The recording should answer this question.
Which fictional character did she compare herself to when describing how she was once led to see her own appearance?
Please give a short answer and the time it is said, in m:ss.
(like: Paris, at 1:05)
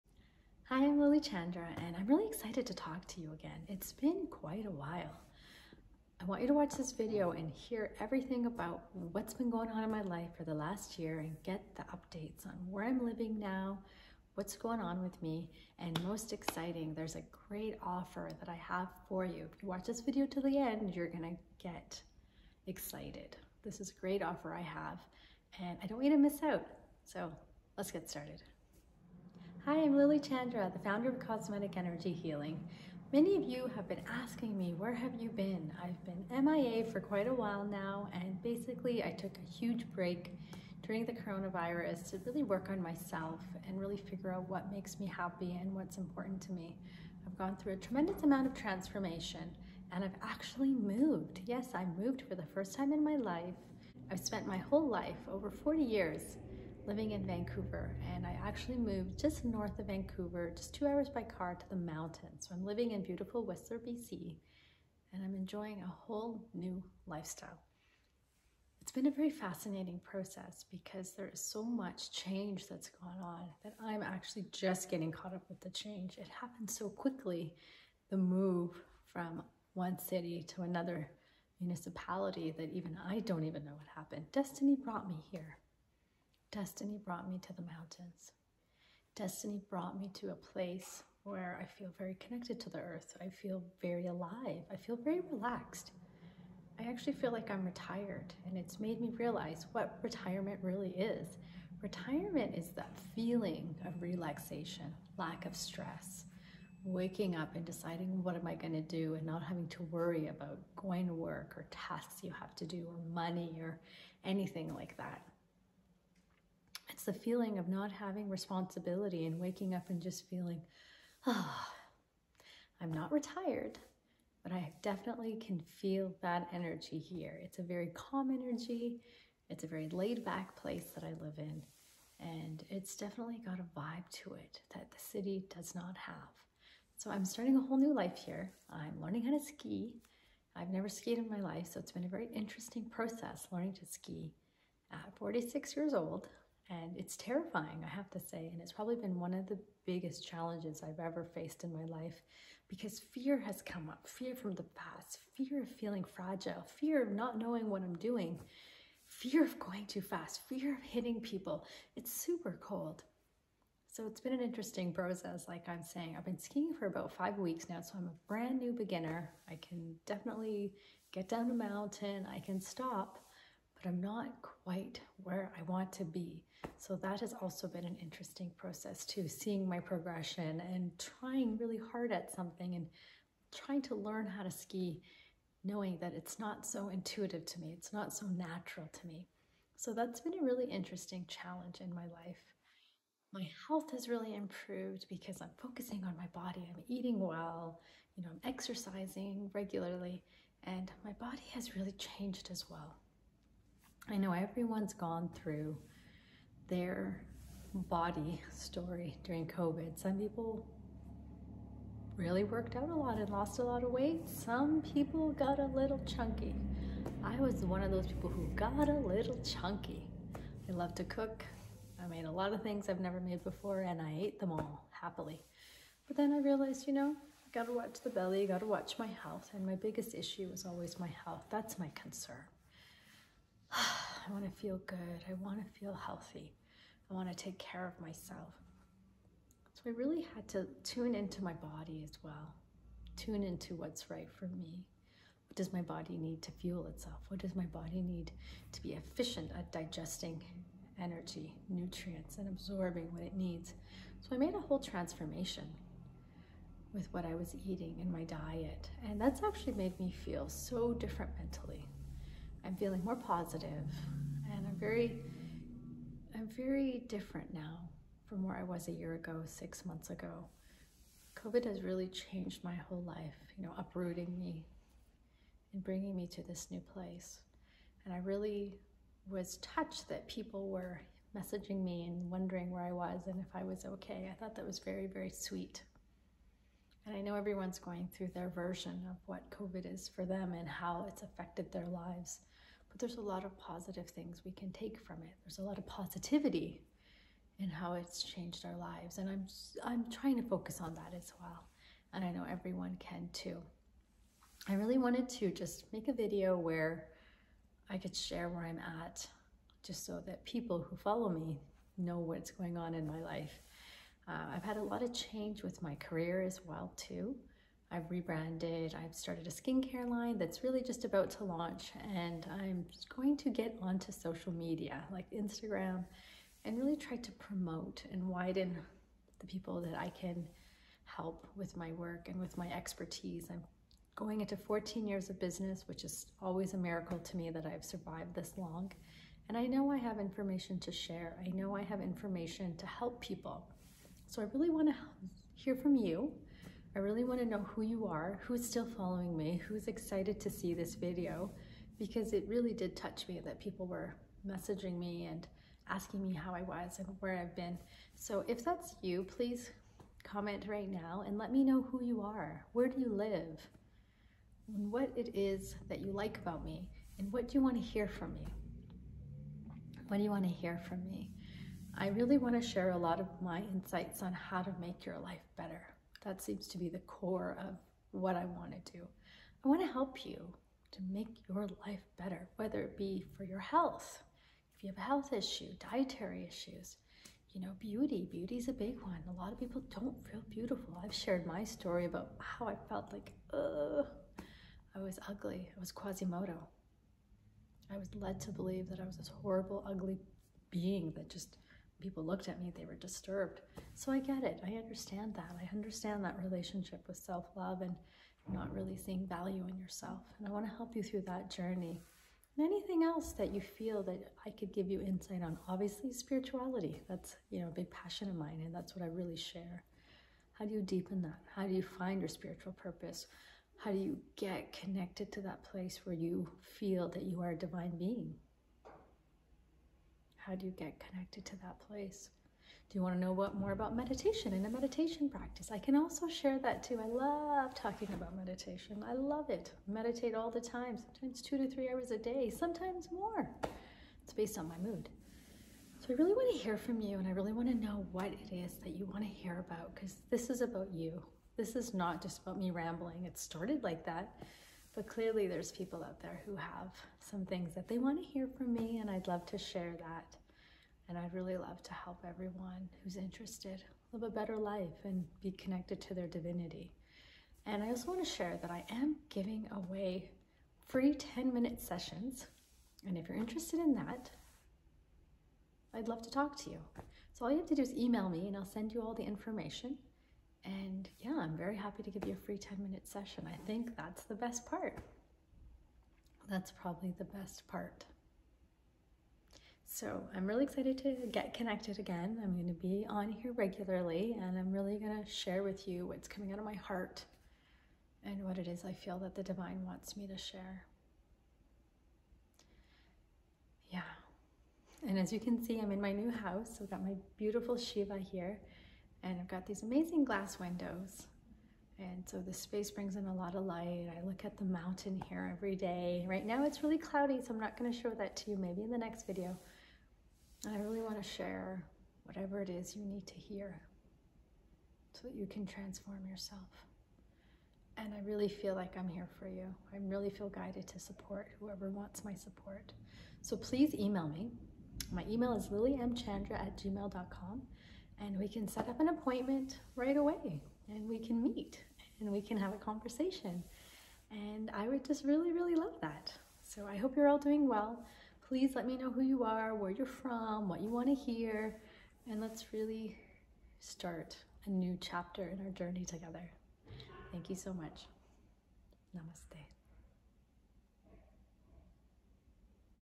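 Quasimodo, at 6:35.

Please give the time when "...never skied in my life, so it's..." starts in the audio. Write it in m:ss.
2:20.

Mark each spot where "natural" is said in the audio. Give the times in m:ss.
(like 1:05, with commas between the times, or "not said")
3:08.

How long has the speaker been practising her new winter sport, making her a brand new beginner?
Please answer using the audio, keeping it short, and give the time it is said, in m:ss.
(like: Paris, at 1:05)
5 weeks, at 2:47.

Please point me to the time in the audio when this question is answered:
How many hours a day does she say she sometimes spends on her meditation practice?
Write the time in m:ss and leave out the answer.
7:21.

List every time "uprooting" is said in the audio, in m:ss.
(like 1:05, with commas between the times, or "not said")
4:33.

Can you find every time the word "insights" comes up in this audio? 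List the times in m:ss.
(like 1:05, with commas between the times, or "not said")
6:13, 6:55.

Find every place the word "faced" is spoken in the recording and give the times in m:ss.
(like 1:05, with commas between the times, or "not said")
2:31.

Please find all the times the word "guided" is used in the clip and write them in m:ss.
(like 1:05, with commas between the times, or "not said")
8:50.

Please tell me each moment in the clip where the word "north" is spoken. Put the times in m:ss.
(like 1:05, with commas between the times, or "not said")
0:59.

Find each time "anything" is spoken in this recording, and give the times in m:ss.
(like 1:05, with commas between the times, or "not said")
1:54, 6:52.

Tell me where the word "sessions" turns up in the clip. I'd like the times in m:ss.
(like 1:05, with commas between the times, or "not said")
7:51, 8:03.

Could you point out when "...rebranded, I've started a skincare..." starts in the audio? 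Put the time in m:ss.
5:18.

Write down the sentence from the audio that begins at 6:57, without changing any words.
That's, you know, a big passion of mine and that's what I really share.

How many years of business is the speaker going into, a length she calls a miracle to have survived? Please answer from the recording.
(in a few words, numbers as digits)
14 years.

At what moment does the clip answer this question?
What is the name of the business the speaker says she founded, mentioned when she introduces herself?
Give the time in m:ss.
0:31.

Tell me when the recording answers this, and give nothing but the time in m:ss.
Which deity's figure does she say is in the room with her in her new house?
8:27.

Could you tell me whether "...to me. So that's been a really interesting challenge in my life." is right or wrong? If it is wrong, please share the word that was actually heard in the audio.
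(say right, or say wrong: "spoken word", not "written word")
right.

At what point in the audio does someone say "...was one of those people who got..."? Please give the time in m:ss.
3:37.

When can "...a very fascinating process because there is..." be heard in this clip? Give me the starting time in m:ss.
1:09.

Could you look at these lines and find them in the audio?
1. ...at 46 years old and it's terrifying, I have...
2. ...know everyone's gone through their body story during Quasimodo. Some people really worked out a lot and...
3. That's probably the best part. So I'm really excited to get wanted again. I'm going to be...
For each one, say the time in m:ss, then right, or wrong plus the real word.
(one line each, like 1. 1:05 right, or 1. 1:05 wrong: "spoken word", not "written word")
1. 2:24 right
2. 3:24 wrong: "COVID", not "Quasimodo"
3. 8:06 wrong: "connected", not "wanted".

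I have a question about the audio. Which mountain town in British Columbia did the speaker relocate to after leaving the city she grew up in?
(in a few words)
Whistler.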